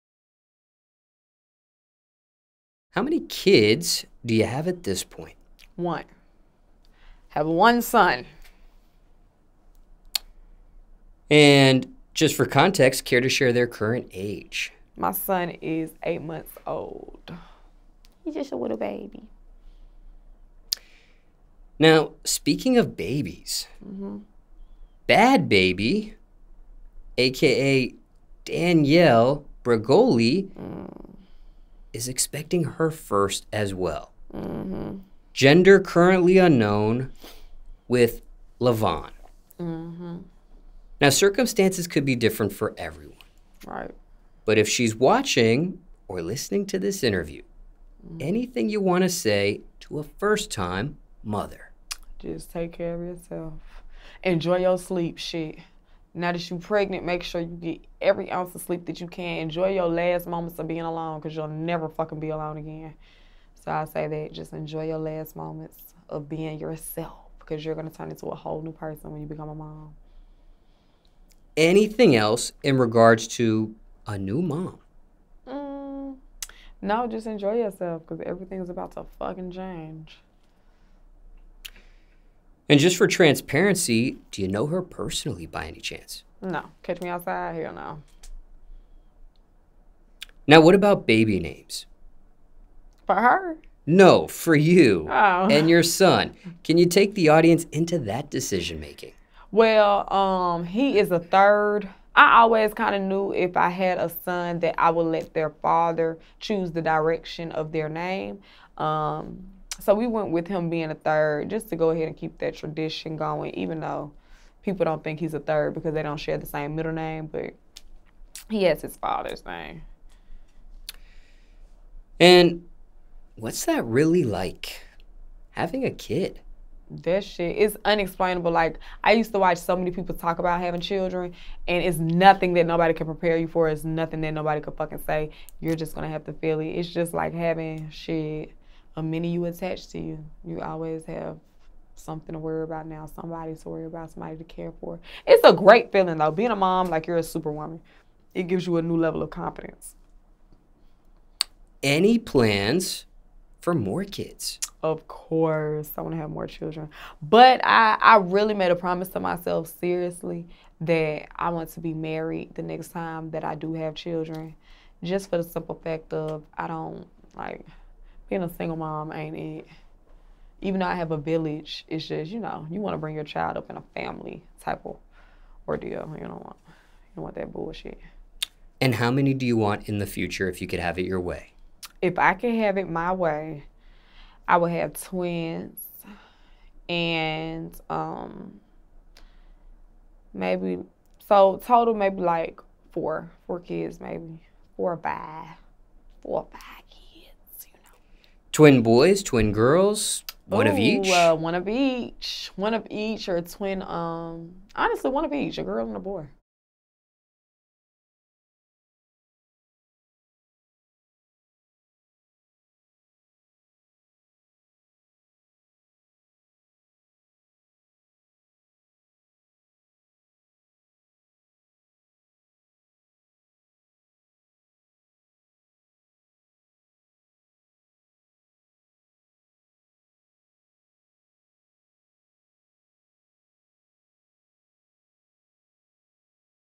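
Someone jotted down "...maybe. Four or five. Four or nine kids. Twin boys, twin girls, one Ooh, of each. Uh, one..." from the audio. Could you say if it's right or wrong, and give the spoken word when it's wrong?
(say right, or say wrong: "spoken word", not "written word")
wrong: "five", not "nine".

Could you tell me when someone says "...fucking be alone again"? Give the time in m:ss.
1:01.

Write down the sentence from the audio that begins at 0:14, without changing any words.
My son is eight months old.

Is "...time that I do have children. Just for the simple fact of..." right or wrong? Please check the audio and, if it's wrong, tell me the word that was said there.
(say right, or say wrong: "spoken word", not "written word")
right.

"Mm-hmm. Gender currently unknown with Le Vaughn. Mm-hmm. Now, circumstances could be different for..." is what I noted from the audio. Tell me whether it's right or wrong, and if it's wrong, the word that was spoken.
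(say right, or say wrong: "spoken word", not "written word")
right.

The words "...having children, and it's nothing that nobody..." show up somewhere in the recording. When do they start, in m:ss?
2:10.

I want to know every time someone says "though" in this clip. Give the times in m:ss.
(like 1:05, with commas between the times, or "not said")
1:53, 2:26, 2:50.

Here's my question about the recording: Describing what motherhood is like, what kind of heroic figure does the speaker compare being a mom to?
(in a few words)
Superwoman.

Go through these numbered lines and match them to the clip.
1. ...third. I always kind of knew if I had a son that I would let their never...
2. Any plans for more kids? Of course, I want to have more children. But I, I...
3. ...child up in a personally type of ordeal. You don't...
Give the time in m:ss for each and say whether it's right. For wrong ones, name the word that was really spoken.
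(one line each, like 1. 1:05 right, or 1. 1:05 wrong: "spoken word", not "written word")
1. 1:41 wrong: "father", not "never"
2. 2:31 right
3. 2:53 wrong: "family", not "personally".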